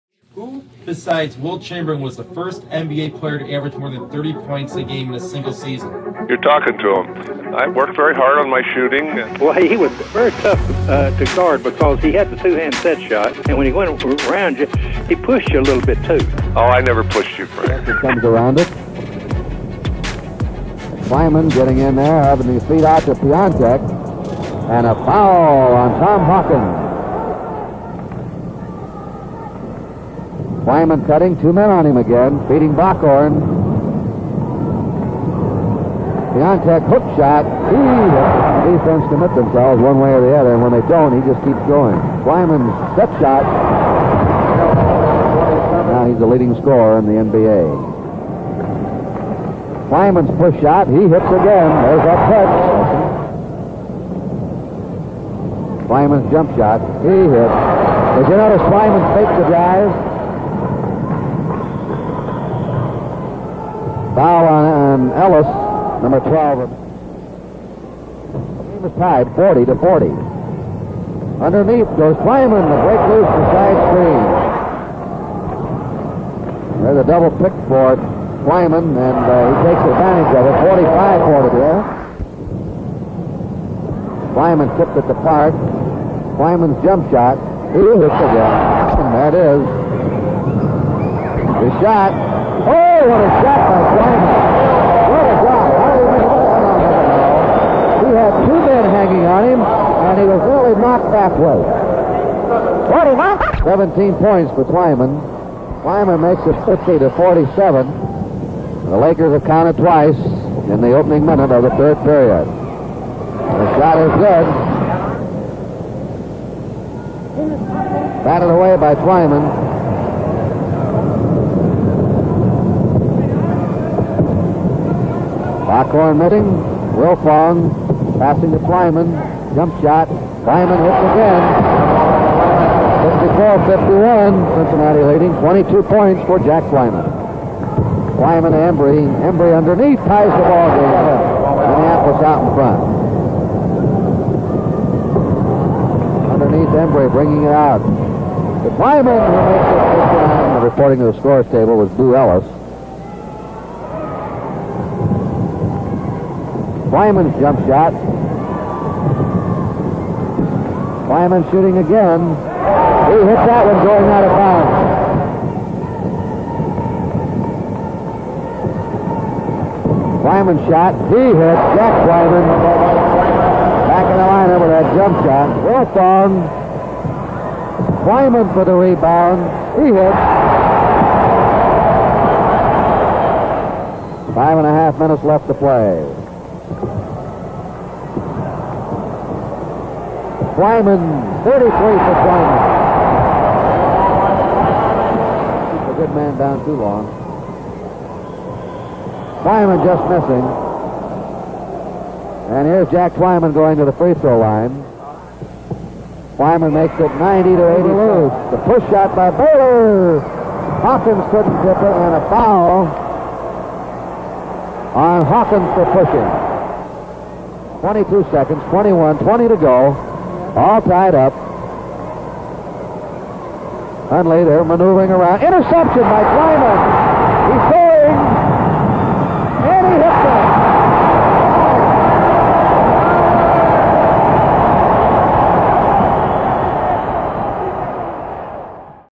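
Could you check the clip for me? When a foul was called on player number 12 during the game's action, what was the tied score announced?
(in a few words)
40 to 40.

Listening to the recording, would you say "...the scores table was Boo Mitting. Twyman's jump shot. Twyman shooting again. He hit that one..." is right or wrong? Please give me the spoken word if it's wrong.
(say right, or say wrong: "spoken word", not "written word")
wrong: "Ellis", not "Mitting".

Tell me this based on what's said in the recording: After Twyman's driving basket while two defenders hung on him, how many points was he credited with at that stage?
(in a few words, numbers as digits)
17.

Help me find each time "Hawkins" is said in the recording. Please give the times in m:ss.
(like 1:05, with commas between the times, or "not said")
0:26, 3:30, 3:35.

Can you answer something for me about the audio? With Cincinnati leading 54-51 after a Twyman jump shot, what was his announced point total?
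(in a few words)
22.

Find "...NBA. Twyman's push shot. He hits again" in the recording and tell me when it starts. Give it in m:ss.
0:47.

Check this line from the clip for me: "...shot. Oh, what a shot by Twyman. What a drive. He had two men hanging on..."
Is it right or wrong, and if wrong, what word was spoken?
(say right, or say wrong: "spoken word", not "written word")
right.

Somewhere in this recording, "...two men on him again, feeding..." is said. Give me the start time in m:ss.
0:31.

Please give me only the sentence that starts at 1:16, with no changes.
There's a double pick for Twyman, and uh, he takes advantage of it.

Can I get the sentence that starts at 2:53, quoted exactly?
Back in the lineup with that jump shot.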